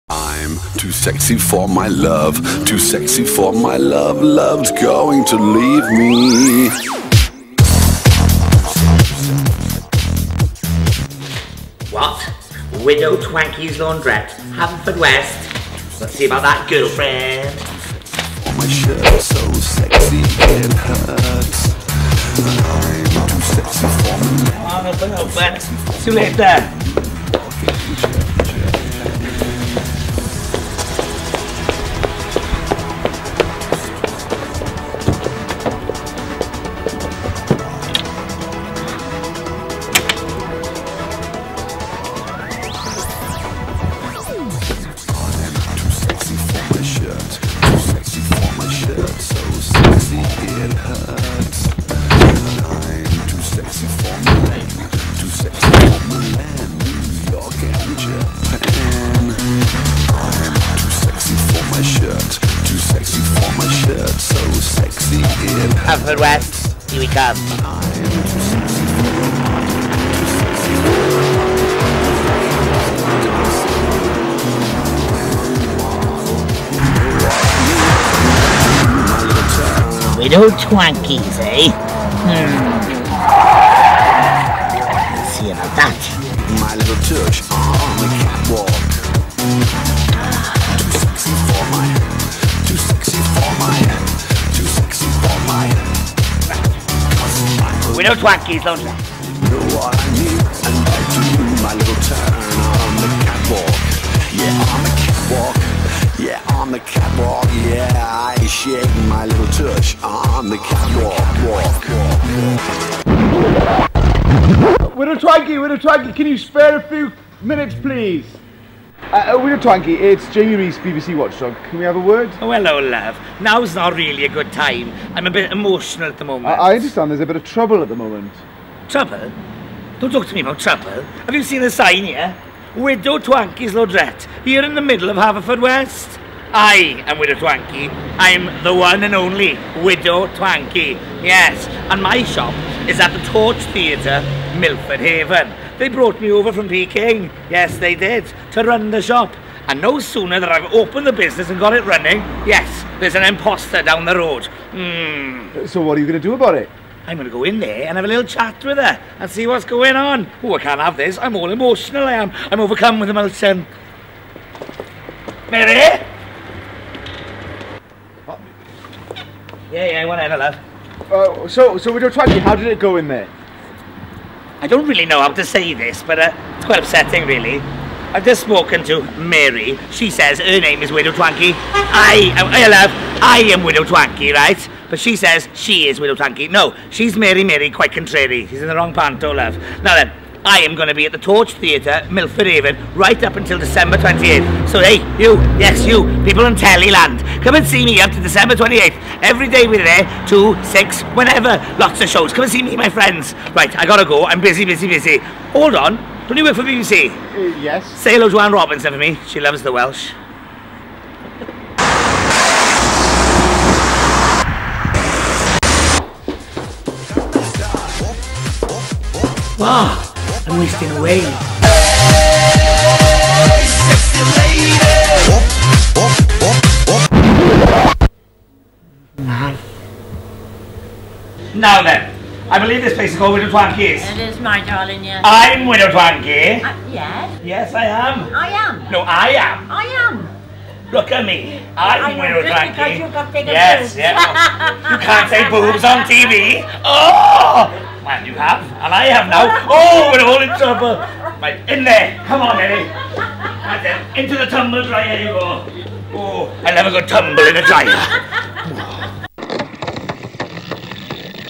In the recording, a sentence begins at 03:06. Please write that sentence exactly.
No, she's Mary Mary, quite contrary.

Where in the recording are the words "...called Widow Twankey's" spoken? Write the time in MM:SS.
03:53.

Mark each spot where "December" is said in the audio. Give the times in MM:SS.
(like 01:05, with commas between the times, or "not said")
03:13, 03:18.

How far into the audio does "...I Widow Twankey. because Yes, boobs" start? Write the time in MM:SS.
04:02.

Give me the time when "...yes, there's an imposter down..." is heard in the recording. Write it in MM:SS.
02:32.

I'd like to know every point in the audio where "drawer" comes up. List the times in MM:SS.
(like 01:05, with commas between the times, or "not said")
not said.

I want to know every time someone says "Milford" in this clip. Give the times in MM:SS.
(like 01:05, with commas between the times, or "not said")
02:24, 03:12.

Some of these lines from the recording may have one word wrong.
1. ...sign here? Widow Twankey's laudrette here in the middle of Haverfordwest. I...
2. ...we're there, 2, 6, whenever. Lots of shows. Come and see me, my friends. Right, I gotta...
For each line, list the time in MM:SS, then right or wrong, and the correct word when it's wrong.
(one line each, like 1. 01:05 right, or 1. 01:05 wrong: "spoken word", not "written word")
1. 02:11 right
2. 03:19 right.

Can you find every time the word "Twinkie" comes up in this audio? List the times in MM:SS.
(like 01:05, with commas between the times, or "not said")
01:55.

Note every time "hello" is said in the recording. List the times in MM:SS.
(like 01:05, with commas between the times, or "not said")
02:02, 03:28.